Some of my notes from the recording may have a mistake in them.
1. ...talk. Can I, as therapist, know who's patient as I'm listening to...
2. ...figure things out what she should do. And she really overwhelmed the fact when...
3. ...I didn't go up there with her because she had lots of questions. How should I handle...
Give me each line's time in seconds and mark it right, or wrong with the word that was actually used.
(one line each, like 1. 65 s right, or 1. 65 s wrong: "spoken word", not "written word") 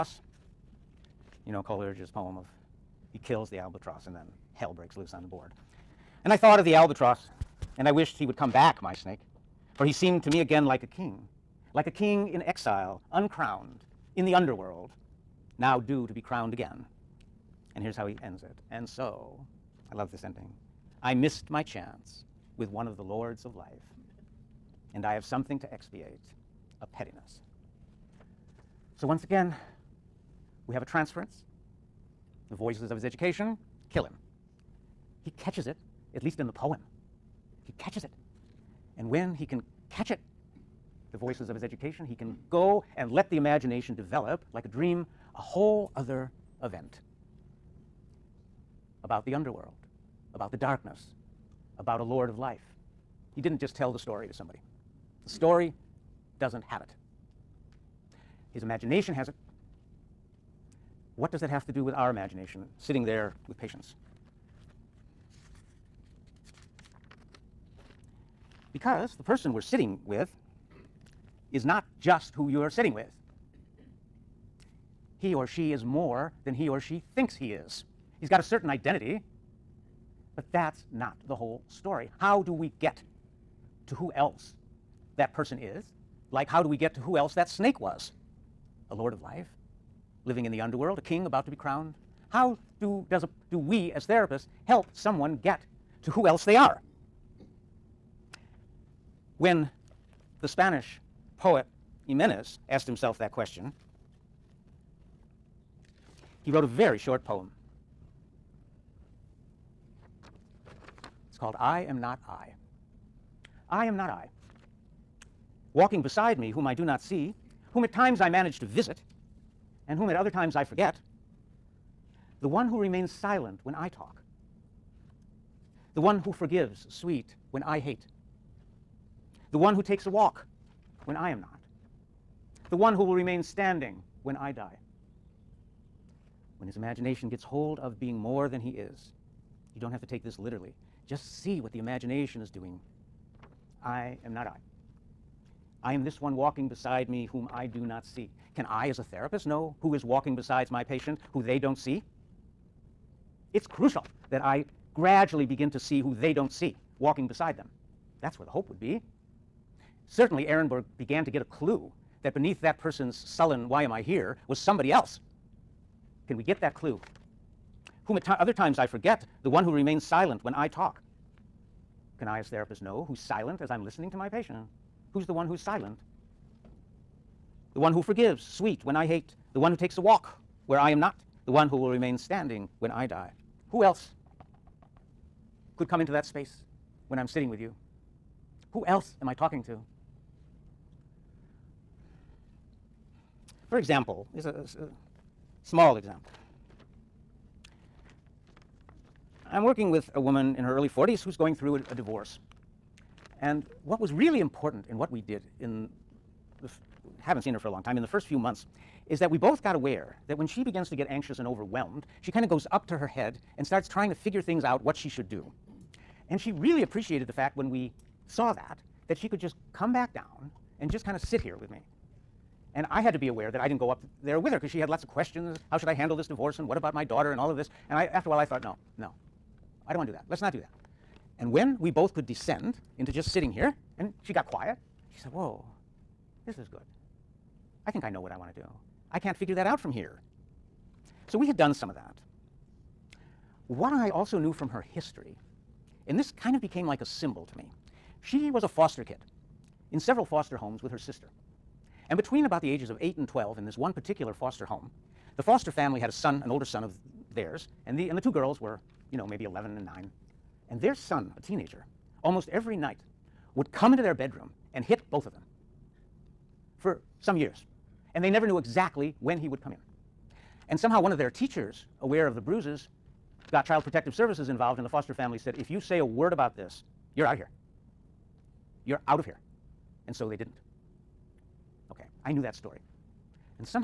1. 170 s wrong: "silent", not "patient"
2. 214 s wrong: "appreciated", not "overwhelmed"
3. 223 s right.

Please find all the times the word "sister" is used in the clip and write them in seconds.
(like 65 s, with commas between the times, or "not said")
250 s.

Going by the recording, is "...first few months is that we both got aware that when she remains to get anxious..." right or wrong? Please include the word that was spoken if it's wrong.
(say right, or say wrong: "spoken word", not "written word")
wrong: "begins", not "remains".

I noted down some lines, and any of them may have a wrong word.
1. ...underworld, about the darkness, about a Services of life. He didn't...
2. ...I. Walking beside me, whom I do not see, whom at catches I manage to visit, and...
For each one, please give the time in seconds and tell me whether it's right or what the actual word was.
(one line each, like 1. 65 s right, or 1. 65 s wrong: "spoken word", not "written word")
1. 49 s wrong: "Lord", not "Services"
2. 114 s wrong: "times", not "catches".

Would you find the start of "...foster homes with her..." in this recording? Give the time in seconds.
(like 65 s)
250 s.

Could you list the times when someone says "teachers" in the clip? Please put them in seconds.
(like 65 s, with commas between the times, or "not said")
271 s.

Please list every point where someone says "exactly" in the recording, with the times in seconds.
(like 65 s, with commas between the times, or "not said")
268 s.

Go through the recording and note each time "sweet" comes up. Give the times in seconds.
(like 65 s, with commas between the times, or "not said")
126 s, 178 s.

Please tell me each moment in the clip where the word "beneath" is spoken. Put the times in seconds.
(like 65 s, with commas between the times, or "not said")
162 s.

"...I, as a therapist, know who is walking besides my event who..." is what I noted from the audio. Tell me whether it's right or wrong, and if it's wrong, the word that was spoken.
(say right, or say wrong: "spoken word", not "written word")
wrong: "patient", not "event".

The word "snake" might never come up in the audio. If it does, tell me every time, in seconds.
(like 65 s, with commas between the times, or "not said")
8 s, 87 s.